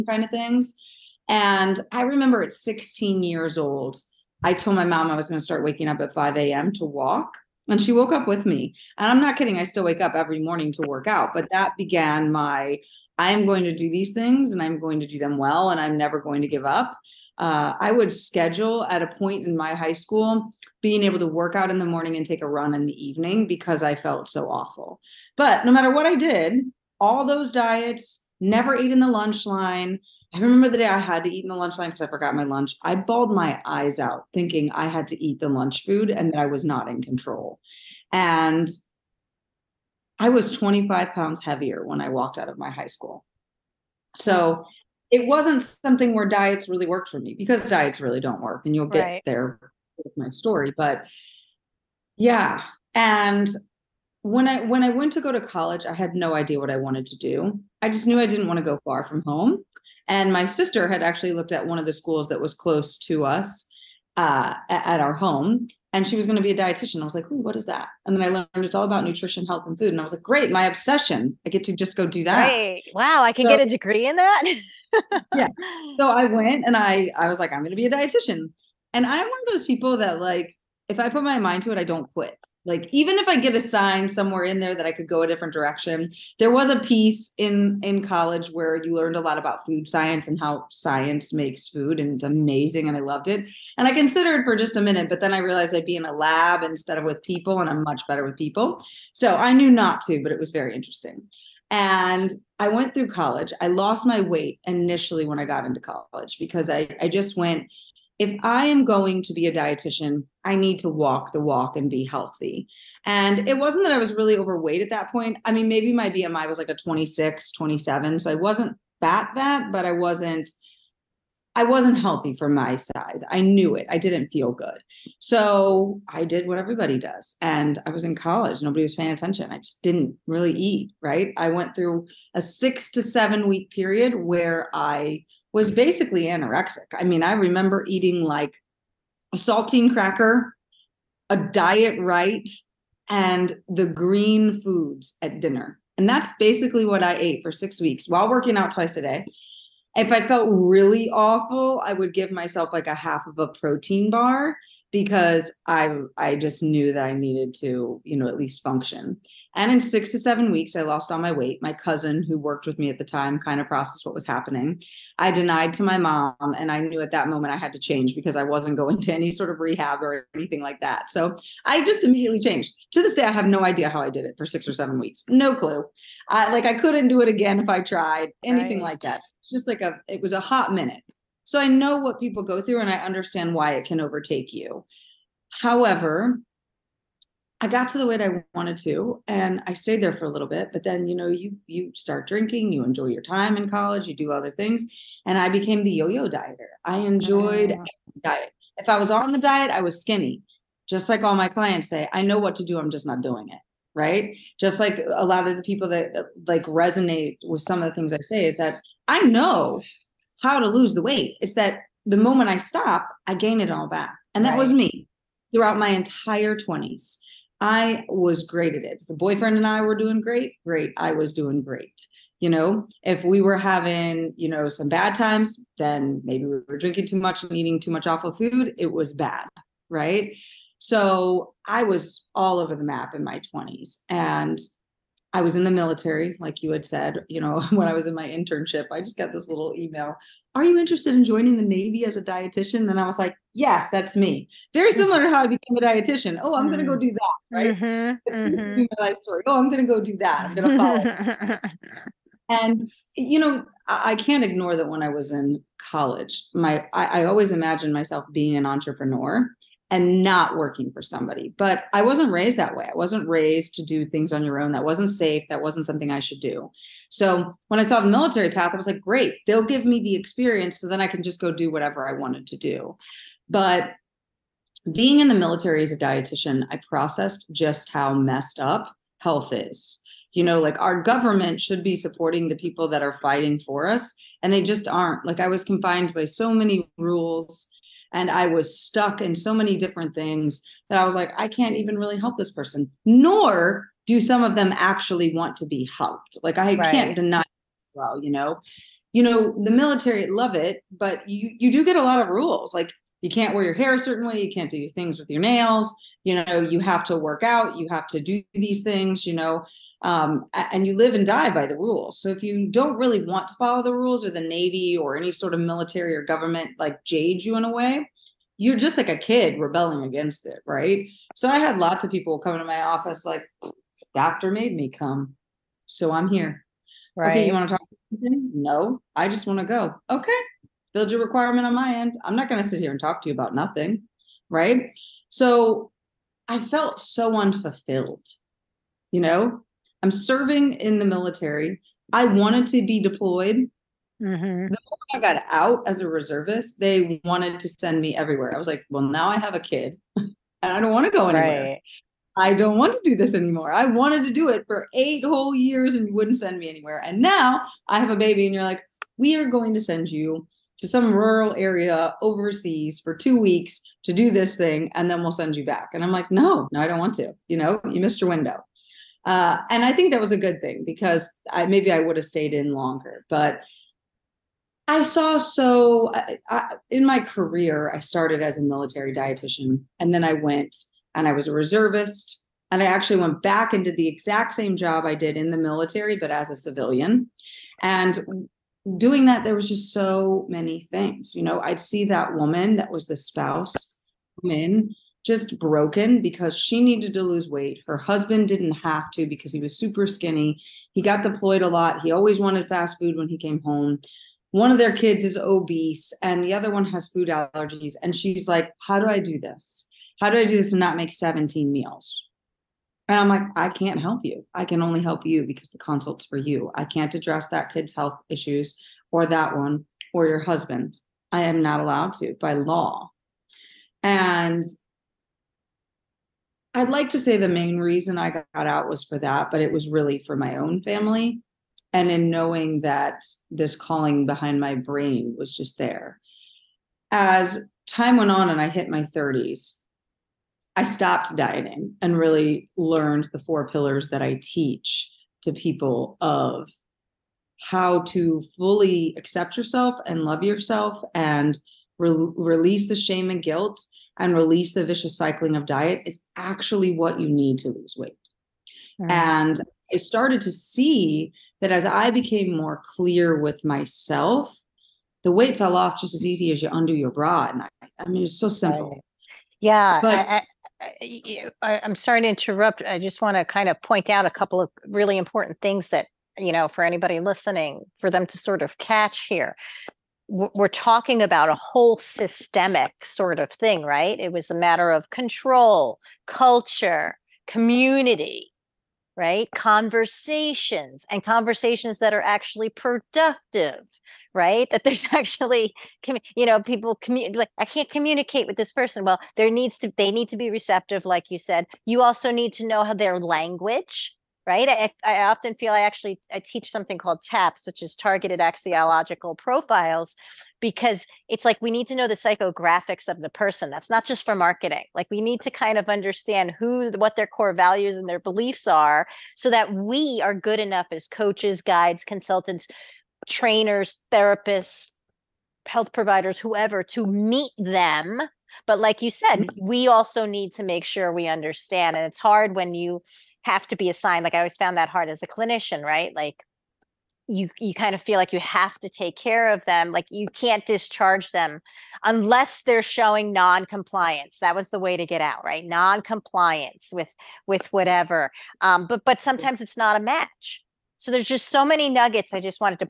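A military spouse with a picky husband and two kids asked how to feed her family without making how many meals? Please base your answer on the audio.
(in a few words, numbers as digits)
17.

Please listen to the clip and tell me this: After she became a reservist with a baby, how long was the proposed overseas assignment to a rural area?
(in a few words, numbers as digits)
2 weeks.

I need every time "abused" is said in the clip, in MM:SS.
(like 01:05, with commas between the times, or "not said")
not said.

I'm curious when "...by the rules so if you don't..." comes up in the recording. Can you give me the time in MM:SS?
05:11.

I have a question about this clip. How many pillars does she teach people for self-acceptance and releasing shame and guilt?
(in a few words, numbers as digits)
4.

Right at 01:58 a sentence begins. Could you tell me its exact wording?
So I wasn't fat that, but I wasn't I wasn't healthy for my size.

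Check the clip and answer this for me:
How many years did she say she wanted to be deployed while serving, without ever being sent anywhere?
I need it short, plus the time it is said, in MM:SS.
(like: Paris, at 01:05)
8, at 05:54.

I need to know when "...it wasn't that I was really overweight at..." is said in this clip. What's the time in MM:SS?
01:53.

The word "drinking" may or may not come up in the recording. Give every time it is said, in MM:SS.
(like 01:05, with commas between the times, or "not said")
03:12, 03:46.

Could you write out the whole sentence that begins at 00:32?
I bawled my eyes out thinking I had to eat the lunch food and that I was not in control.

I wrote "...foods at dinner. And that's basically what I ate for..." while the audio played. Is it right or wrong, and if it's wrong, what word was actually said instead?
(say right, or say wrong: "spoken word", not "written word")
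right.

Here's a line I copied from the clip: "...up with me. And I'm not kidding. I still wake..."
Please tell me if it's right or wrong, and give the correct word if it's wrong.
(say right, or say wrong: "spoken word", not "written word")
right.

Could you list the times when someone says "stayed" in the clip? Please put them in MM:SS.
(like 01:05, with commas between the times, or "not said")
03:09, 06:12.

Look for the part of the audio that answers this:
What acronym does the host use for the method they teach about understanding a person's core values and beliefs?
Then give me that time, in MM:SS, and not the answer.
08:27.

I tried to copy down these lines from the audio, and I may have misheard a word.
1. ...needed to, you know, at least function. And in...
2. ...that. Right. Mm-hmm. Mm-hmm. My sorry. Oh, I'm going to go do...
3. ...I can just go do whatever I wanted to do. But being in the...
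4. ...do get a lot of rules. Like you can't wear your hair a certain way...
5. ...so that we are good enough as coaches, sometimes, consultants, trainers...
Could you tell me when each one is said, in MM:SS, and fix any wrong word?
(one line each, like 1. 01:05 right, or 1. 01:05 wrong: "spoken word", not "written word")
1. 02:37 right
2. 04:07 wrong: "story", not "sorry"
3. 04:31 right
4. 05:01 right
5. 08:39 wrong: "guides", not "sometimes".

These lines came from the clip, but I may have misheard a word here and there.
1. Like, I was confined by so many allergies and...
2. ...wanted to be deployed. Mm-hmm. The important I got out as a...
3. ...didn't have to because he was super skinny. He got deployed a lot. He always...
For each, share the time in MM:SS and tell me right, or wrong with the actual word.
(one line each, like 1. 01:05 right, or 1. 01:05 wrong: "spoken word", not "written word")
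1. 04:45 wrong: "rules", not "allergies"
2. 05:42 wrong: "moment", not "important"
3. 06:38 right.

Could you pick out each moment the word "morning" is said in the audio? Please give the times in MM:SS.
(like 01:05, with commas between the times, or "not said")
00:10, 00:21.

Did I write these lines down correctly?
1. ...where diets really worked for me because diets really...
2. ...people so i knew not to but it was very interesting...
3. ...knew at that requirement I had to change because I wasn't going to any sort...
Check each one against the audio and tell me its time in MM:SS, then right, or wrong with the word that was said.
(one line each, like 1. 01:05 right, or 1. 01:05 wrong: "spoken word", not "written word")
1. 00:46 right
2. 01:38 right
3. 02:46 wrong: "moment", not "requirement".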